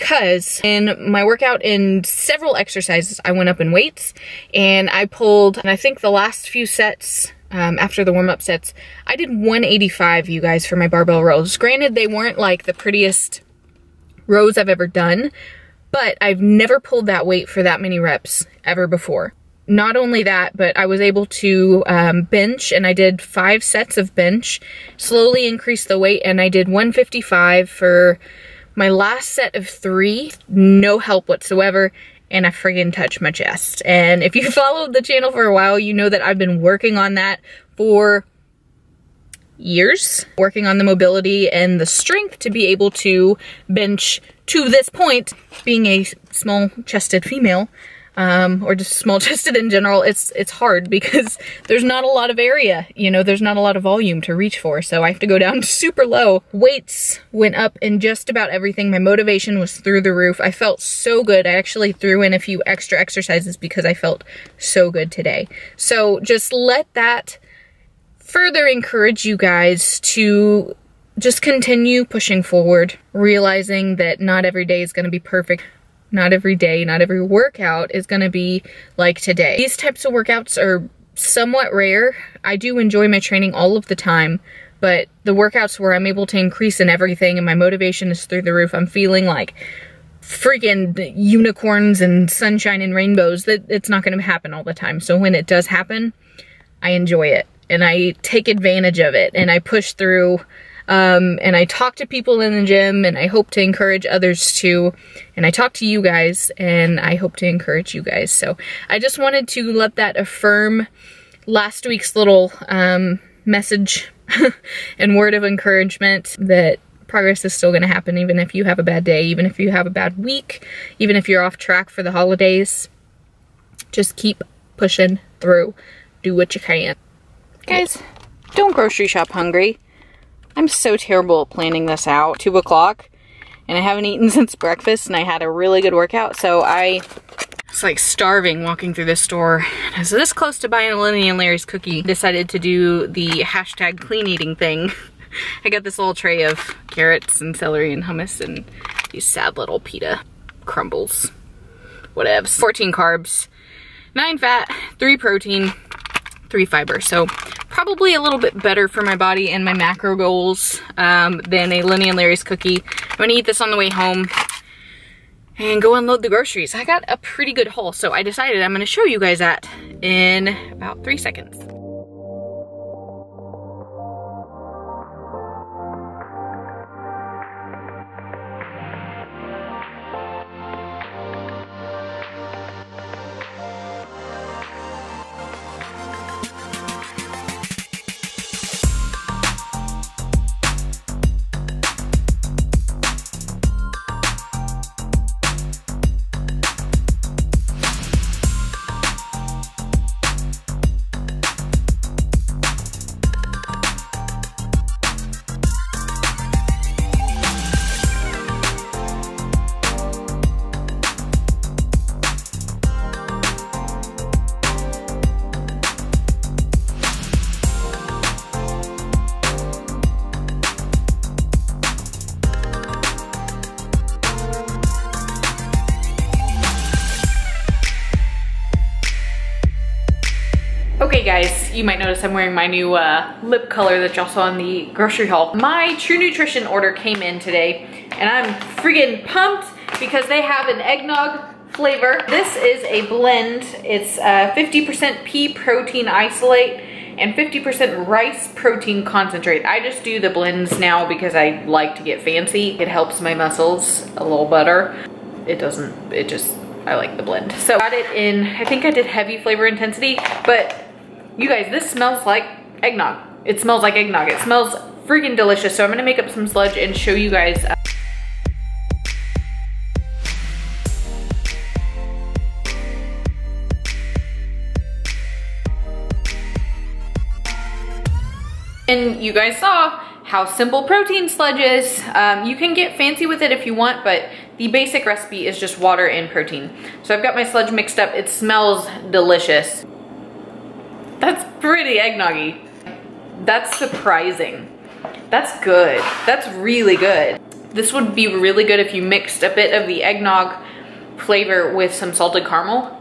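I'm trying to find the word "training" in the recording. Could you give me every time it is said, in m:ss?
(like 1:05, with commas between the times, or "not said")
1:23.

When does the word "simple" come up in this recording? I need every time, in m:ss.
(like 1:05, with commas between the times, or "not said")
4:40.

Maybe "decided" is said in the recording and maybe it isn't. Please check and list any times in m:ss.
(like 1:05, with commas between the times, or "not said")
2:22, 2:48.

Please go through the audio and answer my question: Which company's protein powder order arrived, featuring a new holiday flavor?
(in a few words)
True Nutrition.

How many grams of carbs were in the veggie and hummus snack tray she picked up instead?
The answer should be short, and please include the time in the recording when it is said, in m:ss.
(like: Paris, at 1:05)
14, at 2:32.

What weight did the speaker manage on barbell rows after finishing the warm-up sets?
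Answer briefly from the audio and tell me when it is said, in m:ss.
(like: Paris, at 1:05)
185, at 0:09.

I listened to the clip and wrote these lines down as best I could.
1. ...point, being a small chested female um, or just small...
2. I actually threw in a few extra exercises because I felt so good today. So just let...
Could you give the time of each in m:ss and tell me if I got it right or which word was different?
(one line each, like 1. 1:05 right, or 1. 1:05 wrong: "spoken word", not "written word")
1. 0:44 right
2. 1:01 right.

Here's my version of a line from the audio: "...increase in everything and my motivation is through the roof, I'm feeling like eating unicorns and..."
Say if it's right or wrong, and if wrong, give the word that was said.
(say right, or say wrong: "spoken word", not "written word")
wrong: "freaking", not "eating".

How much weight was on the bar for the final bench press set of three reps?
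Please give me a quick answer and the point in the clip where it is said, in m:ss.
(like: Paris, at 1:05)
155, at 0:26.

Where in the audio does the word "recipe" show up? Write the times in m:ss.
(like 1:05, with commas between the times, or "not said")
4:45.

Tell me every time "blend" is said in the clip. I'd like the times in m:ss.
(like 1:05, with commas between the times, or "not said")
4:03, 4:10, 4:17.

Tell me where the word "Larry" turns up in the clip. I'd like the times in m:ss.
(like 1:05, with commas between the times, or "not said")
2:21, 2:42.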